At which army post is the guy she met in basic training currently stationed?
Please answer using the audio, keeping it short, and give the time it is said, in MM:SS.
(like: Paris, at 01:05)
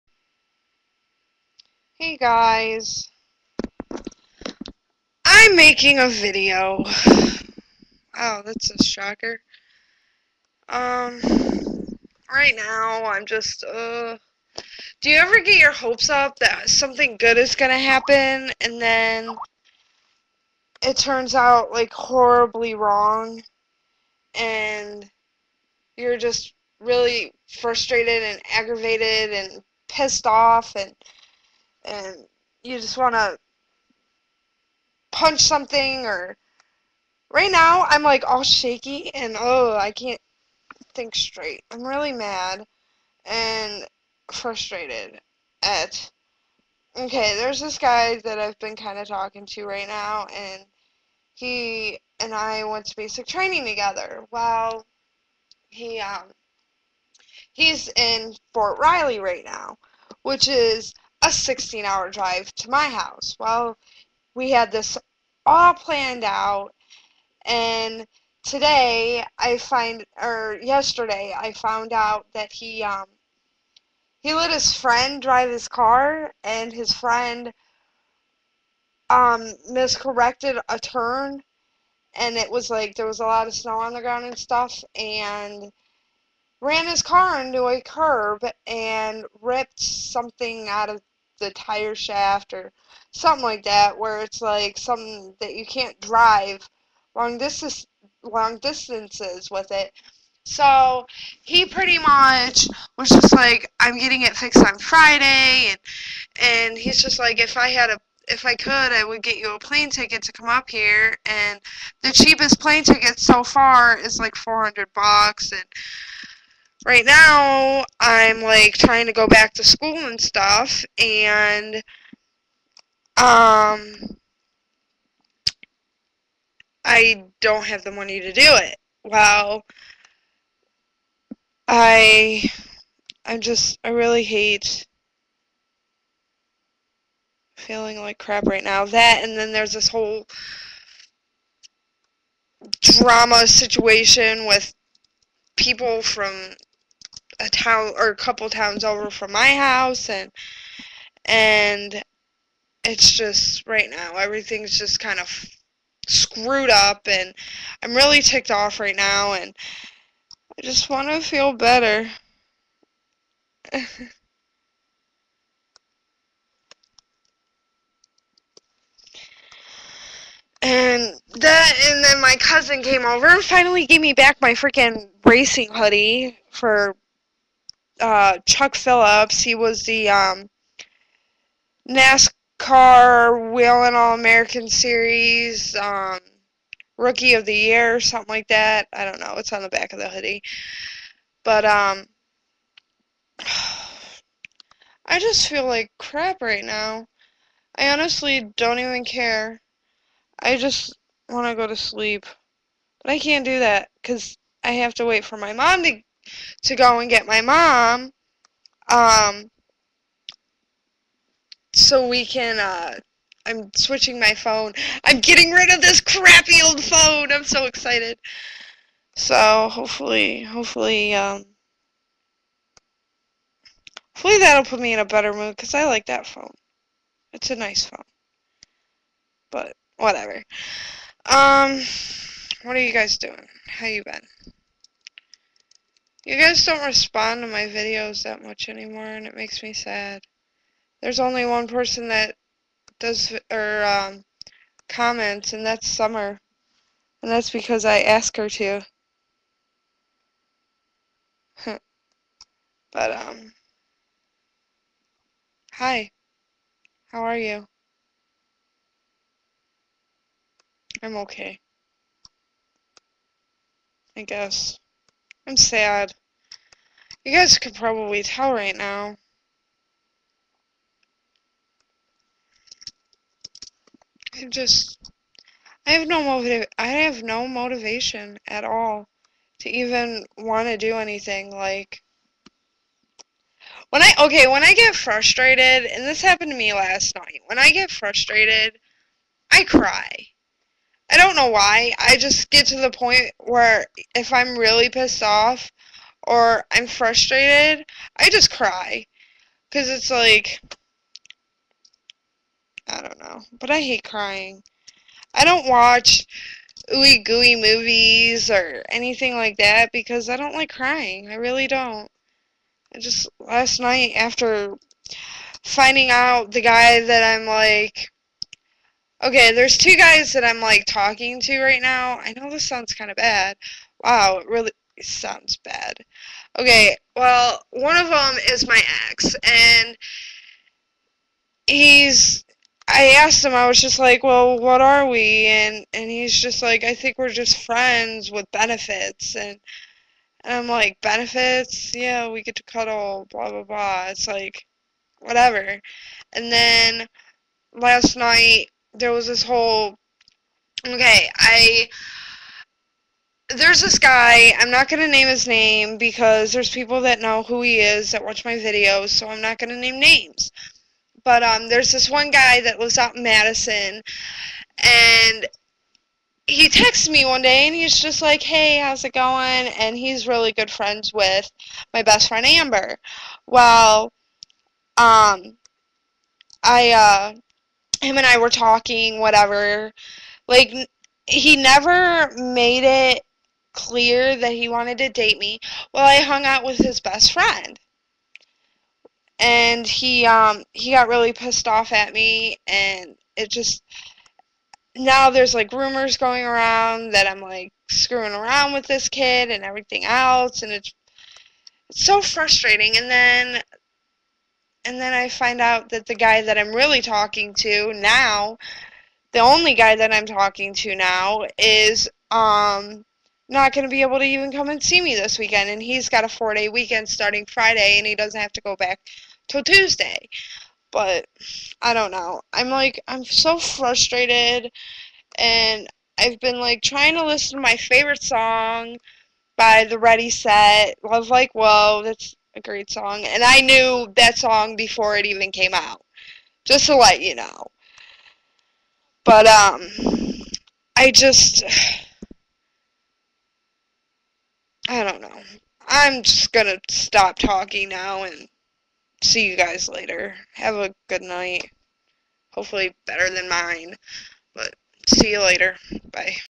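Fort Riley, at 00:58.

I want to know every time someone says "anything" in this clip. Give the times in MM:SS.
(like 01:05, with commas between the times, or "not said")
04:40, 05:08.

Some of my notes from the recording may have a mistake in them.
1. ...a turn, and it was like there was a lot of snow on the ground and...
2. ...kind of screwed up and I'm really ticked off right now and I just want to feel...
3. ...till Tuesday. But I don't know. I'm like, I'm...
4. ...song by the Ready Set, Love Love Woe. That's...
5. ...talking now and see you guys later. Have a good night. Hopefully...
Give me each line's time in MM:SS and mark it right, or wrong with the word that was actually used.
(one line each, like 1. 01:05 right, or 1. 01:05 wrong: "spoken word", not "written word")
1. 01:20 right
2. 02:34 right
3. 06:59 right
4. 07:08 wrong: "Like", not "Love"
5. 07:27 right.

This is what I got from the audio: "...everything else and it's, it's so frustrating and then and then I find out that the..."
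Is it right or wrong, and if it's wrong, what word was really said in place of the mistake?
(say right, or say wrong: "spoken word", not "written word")
right.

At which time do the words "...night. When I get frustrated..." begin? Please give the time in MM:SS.
04:47.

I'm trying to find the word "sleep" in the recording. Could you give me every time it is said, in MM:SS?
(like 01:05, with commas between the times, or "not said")
03:21.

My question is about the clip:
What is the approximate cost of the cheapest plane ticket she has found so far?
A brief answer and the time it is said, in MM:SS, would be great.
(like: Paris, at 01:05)
$400, at 01:54.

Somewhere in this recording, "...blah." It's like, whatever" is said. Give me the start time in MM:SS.
05:43.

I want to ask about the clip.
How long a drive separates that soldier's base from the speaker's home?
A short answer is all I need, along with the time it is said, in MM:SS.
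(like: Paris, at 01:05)
16 hours, at 01:01.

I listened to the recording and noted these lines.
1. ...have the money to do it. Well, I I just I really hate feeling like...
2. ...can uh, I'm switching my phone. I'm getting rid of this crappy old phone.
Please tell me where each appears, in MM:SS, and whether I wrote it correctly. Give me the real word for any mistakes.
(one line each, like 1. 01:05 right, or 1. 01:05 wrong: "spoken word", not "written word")
1. 02:07 right
2. 03:32 right.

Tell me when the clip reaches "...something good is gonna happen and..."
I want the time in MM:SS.
00:16.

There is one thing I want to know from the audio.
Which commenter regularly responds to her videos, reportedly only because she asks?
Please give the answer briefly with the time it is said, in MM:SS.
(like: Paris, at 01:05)
Summer, at 04:05.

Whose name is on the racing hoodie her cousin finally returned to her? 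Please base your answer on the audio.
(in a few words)
Chuck Phillips.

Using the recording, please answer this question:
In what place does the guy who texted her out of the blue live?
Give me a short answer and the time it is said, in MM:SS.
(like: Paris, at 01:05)
Madison, at 06:03.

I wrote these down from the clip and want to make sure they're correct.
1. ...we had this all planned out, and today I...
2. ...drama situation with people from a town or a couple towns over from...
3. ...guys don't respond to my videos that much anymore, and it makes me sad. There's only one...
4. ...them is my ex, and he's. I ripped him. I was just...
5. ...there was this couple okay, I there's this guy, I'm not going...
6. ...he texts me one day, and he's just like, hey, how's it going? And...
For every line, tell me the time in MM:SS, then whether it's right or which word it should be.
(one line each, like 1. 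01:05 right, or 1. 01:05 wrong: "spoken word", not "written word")
1. 01:04 right
2. 02:22 right
3. 03:56 right
4. 05:28 wrong: "asked", not "ripped"
5. 05:48 wrong: "whole", not "couple"
6. 06:06 right.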